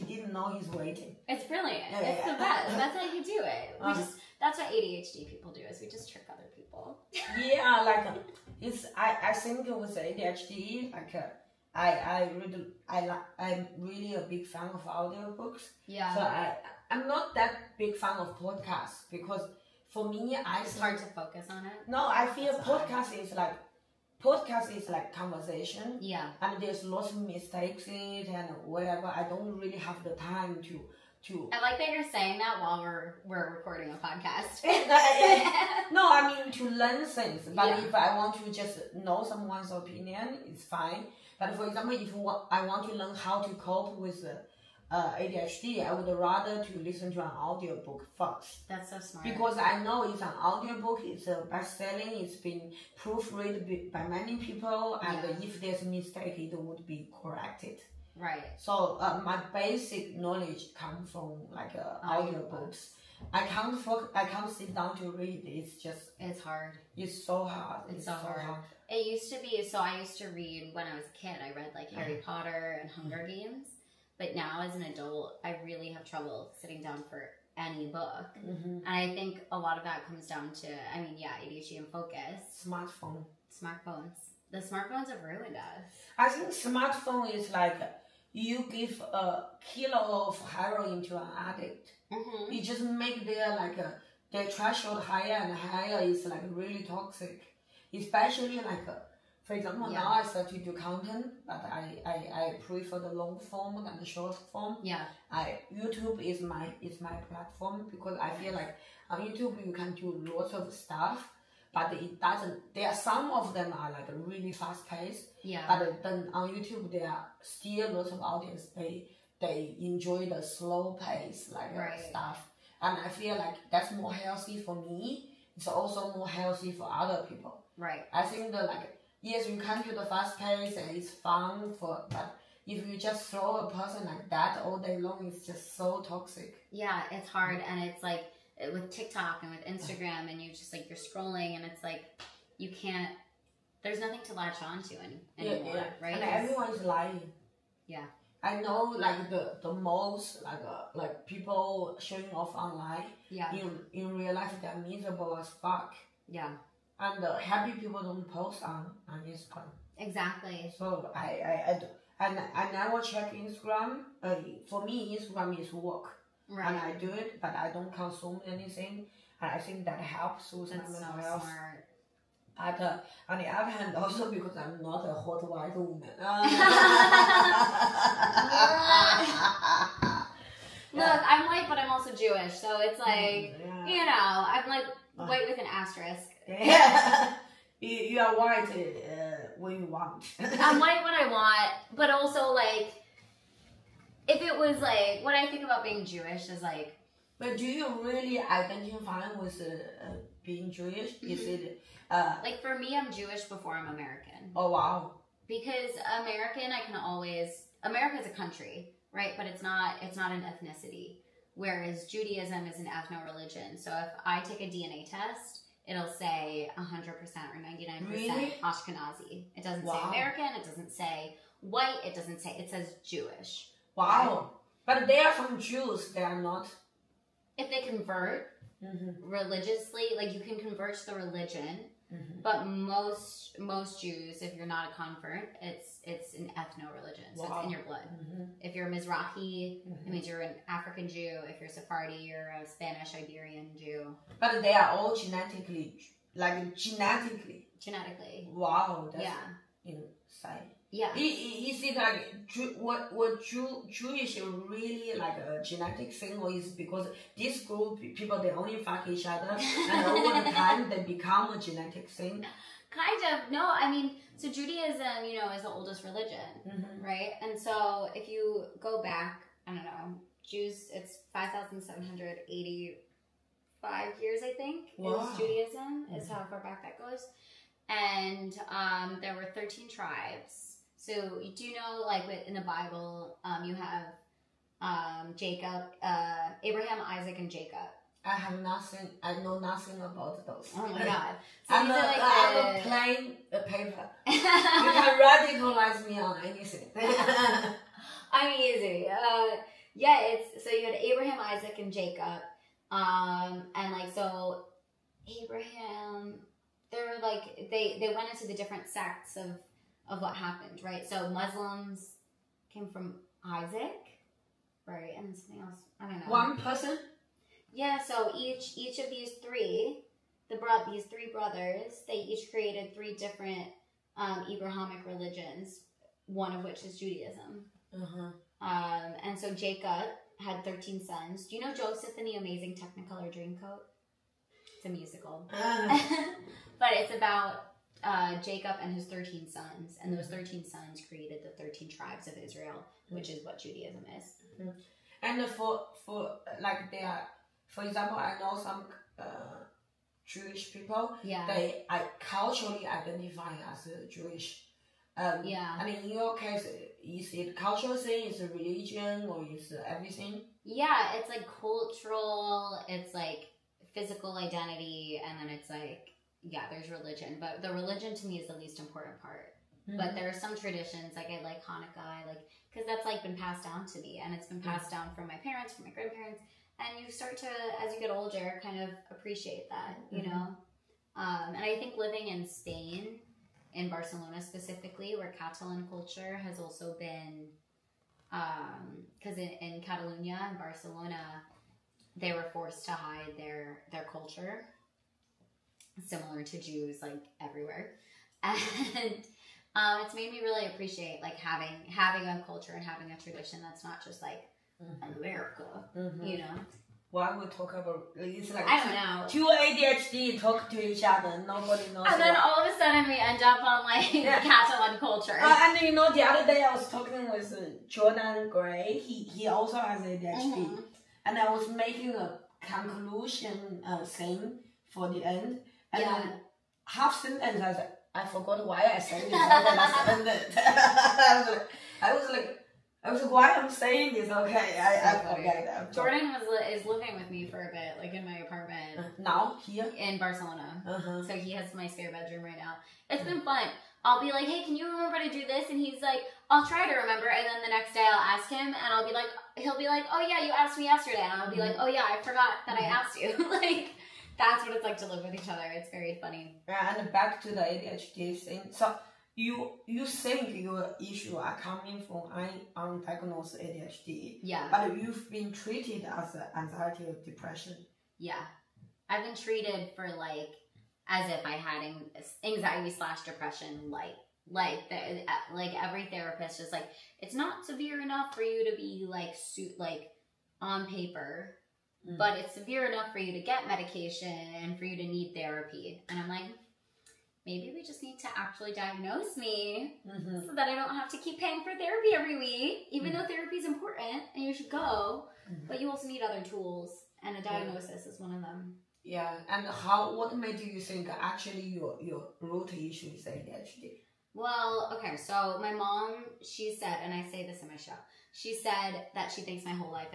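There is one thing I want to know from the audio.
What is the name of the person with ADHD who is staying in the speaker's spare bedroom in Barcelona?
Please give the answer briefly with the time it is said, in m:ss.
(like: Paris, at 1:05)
Jordan Gray, at 6:57.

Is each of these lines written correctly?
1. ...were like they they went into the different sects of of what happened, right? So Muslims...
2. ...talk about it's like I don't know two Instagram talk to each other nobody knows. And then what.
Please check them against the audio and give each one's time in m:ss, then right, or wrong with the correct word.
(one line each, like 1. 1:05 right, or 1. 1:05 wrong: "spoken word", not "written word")
1. 5:06 right
2. 6:47 wrong: "ADHD", not "Instagram".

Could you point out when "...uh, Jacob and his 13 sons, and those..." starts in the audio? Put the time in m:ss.
5:38.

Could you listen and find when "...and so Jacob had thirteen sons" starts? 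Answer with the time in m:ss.
5:29.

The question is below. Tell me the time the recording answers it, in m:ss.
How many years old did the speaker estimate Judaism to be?
4:31.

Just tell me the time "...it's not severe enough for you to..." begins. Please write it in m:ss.
7:57.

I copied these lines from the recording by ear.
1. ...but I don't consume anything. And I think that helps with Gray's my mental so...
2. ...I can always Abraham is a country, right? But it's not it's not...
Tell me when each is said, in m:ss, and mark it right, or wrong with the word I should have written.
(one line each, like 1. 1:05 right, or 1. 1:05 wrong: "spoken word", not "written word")
1. 2:47 wrong: "That", not "Gray"
2. 3:26 wrong: "America", not "Abraham".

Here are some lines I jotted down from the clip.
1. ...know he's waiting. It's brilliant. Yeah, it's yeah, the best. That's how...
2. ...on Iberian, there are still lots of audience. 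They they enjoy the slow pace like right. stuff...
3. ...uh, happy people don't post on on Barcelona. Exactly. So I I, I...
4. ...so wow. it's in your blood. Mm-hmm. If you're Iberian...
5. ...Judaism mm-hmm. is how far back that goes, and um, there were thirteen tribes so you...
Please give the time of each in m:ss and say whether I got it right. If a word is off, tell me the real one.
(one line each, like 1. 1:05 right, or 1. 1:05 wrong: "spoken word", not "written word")
1. 0:00 right
2. 1:56 wrong: "YouTube", not "Iberian"
3. 2:37 wrong: "Instagram", not "Barcelona"
4. 3:57 wrong: "Mizrahi", not "Iberian"
5. 4:35 right.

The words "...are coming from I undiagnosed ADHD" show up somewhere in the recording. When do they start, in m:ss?
7:41.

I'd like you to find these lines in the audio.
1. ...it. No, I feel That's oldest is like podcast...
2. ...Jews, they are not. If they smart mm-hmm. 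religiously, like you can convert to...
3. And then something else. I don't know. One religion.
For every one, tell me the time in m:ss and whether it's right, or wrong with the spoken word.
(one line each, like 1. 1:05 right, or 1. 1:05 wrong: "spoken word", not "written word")
1. 0:21 wrong: "podcast", not "oldest"
2. 3:45 wrong: "convert", not "smart"
3. 5:15 wrong: "person", not "religion".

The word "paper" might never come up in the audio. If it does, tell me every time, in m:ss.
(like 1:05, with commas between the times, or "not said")
4:53, 8:00.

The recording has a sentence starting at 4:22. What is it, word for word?
Kind of no, I mean so Judaism you know is the oldest religion, mm-hmm.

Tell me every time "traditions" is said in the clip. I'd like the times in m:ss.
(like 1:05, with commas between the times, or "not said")
6:10, 6:43.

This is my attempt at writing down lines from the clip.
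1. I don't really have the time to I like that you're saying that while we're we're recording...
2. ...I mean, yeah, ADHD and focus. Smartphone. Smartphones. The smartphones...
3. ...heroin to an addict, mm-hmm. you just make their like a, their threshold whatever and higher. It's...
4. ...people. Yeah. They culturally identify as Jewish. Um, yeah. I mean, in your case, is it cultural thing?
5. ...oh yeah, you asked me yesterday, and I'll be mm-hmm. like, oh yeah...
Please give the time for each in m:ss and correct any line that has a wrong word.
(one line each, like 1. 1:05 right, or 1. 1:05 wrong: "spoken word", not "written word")
1. 0:29 right
2. 1:20 right
3. 1:30 wrong: "higher", not "whatever"
4. 5:50 right
5. 7:30 right.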